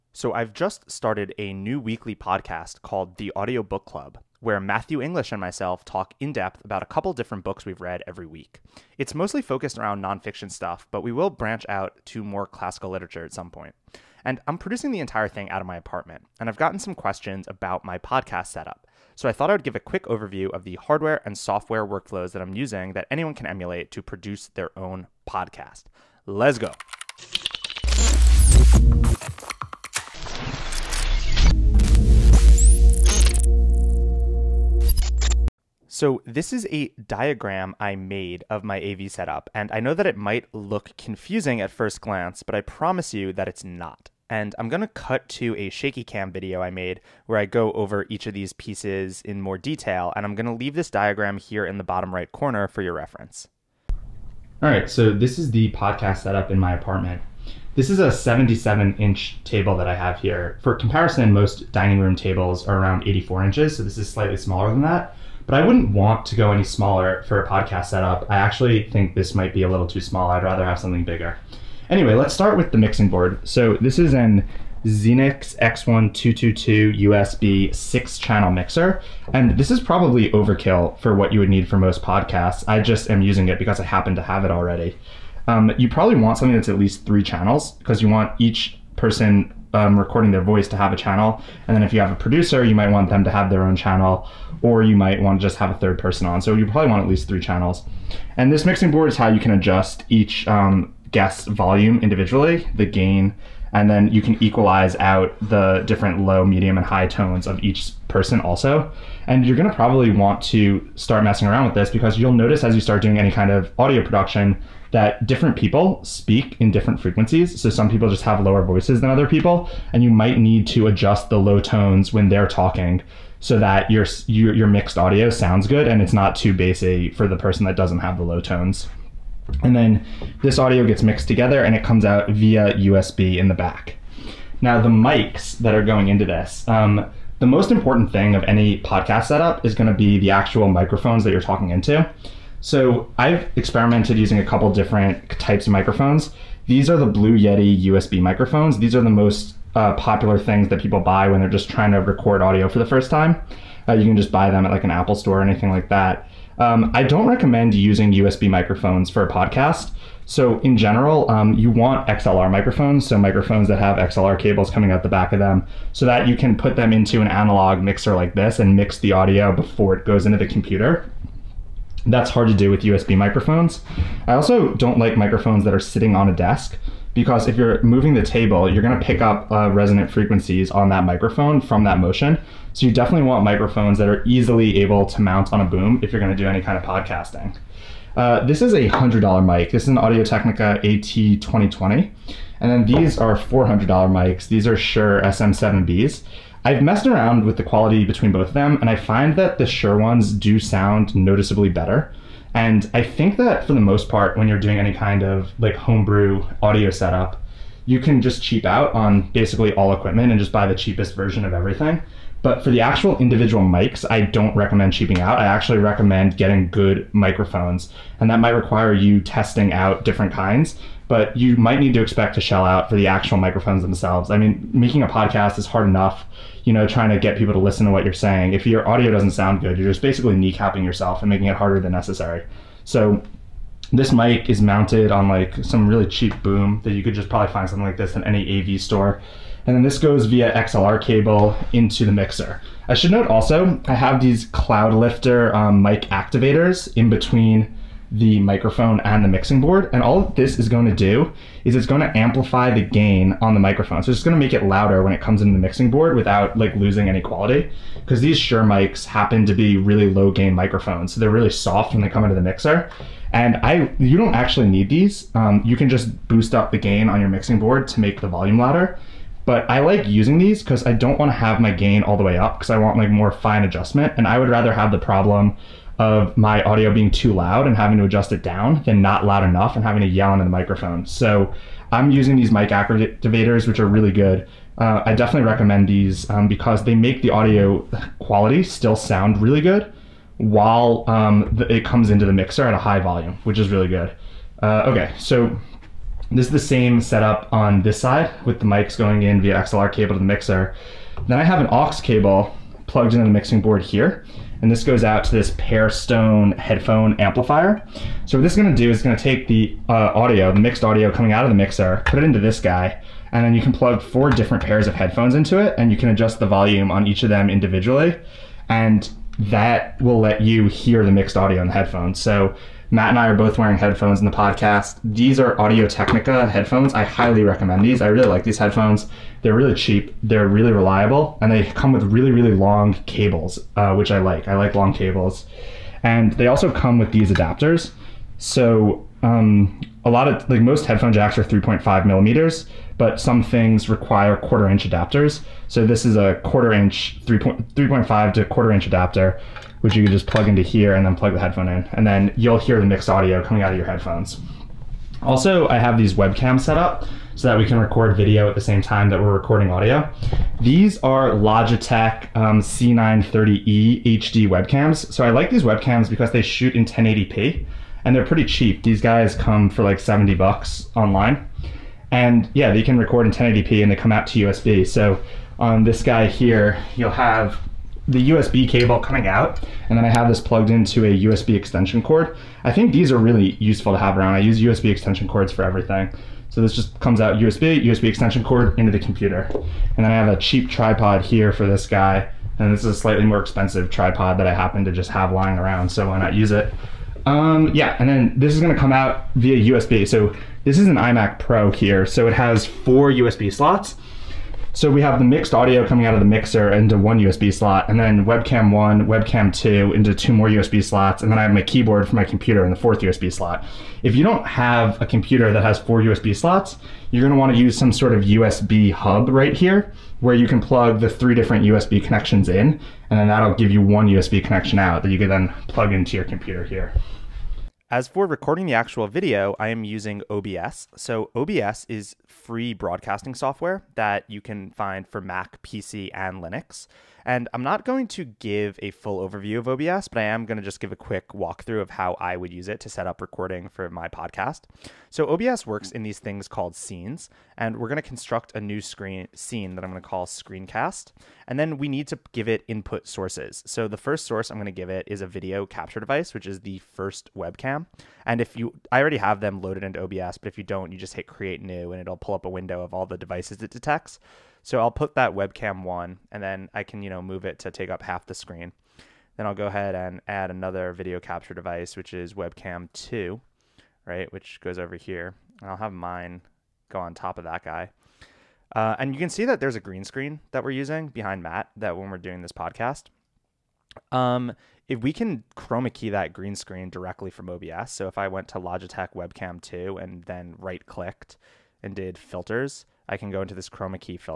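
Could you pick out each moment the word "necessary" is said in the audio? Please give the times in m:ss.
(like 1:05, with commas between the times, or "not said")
3:51.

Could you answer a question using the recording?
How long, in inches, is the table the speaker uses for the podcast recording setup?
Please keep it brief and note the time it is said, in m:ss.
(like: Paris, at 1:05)
77 inches, at 0:58.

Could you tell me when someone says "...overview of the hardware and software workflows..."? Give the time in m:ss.
0:20.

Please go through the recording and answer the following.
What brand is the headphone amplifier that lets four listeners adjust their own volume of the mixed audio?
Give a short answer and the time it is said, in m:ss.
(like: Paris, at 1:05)
Pearstone, at 5:05.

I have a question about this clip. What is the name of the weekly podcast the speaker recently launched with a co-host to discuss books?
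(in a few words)
The Audio Book Club.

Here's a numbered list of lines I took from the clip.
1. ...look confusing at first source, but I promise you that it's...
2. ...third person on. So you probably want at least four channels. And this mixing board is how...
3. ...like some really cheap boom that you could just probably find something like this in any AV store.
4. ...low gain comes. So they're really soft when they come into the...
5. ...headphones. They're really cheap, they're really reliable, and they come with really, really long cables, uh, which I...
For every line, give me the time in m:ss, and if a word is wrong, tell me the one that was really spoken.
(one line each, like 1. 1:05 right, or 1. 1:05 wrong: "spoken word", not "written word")
1. 0:40 wrong: "glance", not "source"
2. 1:35 wrong: "three", not "four"
3. 3:55 right
4. 4:20 wrong: "microphones", not "comes"
5. 5:28 right.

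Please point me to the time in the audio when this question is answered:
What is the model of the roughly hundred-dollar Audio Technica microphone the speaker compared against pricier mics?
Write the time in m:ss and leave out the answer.
3:10.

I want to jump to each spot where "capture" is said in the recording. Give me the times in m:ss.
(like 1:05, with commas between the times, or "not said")
7:35, 7:51.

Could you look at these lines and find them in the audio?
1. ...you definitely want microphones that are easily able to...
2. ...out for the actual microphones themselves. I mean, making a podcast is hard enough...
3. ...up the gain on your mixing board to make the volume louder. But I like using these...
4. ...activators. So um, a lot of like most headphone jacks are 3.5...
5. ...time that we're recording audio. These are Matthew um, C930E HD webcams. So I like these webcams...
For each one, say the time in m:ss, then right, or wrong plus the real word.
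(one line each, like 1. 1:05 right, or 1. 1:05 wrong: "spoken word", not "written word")
1. 3:02 right
2. 3:42 right
3. 4:26 right
4. 5:37 wrong: "adapters", not "activators"
5. 5:58 wrong: "Logitech", not "Matthew".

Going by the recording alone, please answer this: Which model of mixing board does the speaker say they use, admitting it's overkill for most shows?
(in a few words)
Xenyx X1222.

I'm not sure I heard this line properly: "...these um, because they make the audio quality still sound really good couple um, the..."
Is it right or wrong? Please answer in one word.
wrong.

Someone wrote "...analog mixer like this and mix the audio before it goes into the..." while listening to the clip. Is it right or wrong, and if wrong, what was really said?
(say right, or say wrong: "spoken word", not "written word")
right.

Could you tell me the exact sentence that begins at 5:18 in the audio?
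And that will let you hear the mixed audio in the headphones.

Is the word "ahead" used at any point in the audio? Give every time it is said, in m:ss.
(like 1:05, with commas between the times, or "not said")
7:49.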